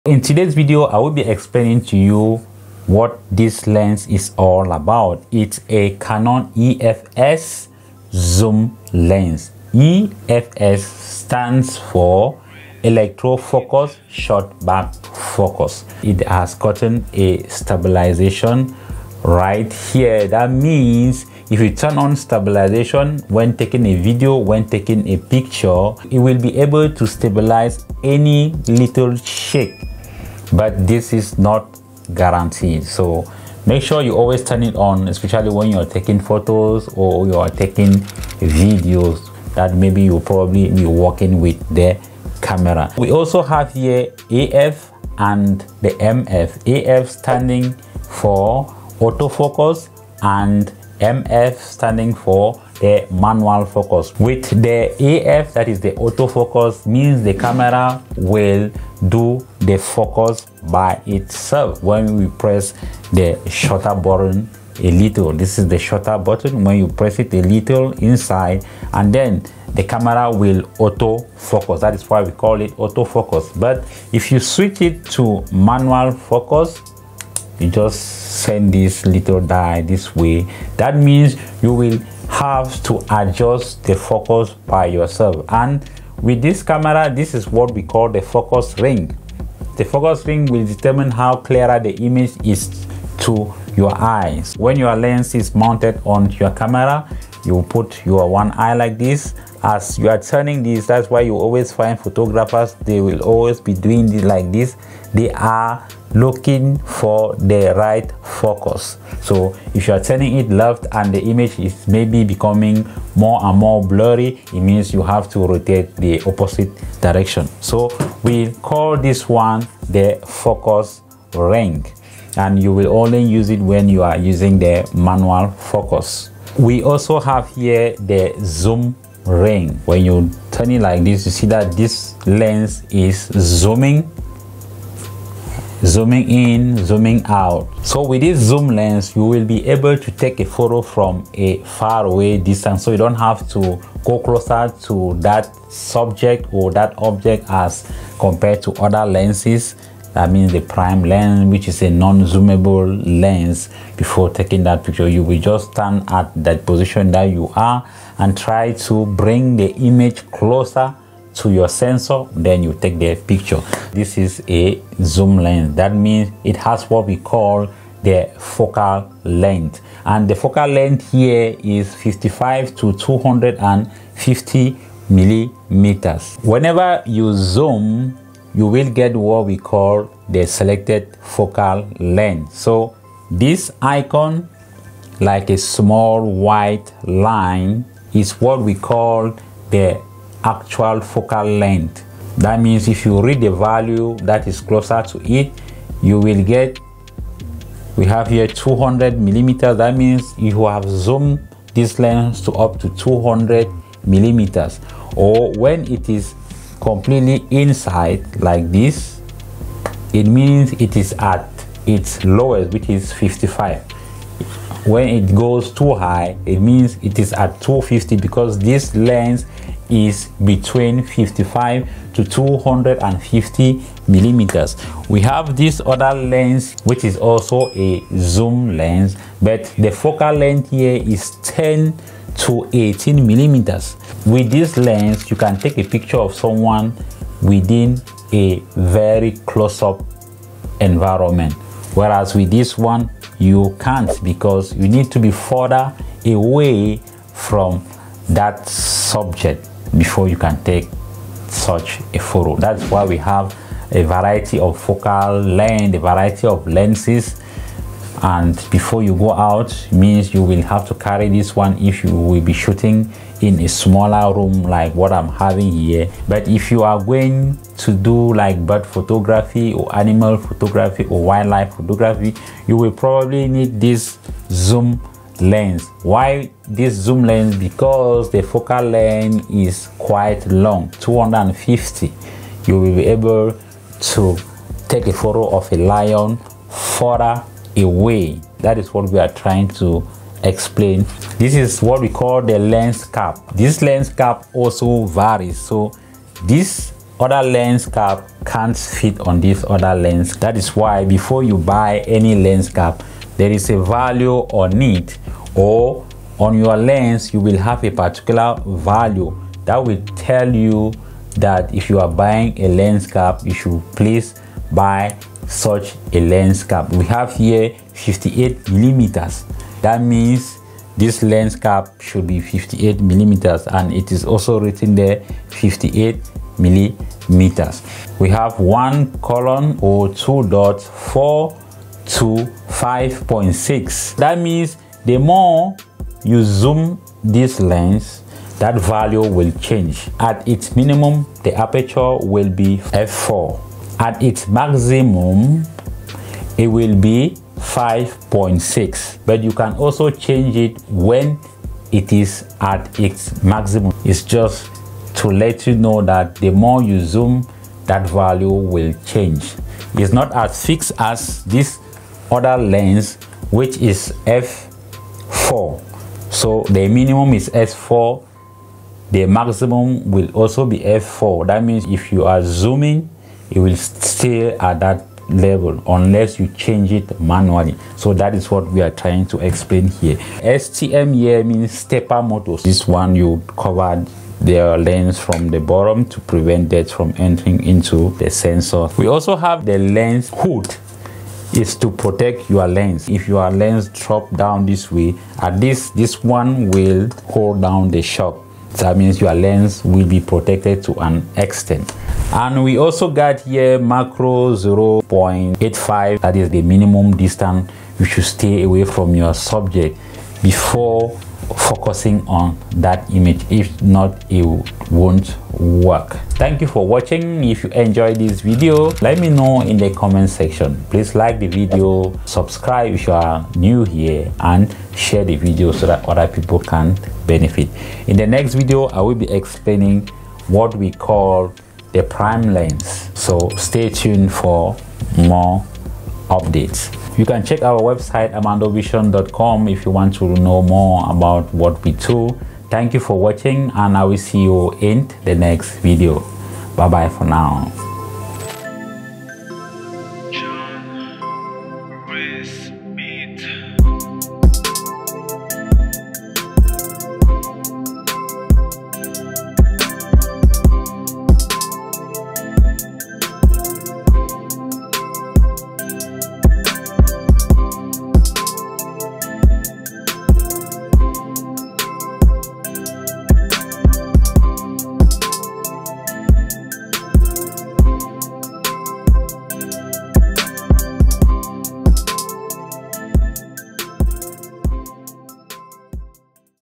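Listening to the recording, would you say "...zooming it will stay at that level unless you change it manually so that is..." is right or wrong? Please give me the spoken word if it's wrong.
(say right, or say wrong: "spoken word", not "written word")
right.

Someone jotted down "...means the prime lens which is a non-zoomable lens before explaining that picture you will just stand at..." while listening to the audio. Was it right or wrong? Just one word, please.
wrong.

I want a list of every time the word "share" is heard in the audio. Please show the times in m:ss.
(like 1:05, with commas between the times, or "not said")
7:04.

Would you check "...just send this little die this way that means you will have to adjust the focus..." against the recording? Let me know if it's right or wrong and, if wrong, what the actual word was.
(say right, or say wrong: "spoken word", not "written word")
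right.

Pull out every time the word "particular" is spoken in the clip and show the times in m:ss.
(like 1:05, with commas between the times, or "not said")
5:07.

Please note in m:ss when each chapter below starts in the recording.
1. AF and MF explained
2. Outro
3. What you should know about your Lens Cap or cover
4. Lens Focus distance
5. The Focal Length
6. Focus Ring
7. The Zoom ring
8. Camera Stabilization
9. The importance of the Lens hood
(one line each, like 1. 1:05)
1. 0:42
2. 6:56
3. 4:51
4. 6:42
5. 2:43
6. 1:27
7. 2:06
8. 0:15
9. 6:28.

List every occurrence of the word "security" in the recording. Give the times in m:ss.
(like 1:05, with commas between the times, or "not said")
not said.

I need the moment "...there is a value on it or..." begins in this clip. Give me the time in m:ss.
5:03.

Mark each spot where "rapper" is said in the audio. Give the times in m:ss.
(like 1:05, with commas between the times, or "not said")
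not said.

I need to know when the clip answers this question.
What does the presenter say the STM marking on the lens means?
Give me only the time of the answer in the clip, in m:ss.
6:21.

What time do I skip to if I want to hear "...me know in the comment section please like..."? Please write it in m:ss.
6:59.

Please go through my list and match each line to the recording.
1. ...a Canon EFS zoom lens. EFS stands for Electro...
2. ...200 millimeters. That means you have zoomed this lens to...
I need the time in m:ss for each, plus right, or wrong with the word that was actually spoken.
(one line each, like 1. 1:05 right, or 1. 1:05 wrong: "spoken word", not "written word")
1. 0:05 right
2. 3:18 right.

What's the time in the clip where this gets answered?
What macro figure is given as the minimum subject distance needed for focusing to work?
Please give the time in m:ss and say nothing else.
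6:44.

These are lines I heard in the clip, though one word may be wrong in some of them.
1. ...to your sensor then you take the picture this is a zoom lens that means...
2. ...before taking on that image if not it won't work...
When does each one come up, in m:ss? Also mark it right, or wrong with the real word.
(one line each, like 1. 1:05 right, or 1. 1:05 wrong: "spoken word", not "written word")
1. 2:41 right
2. 6:50 wrong: "focusing", not "taking".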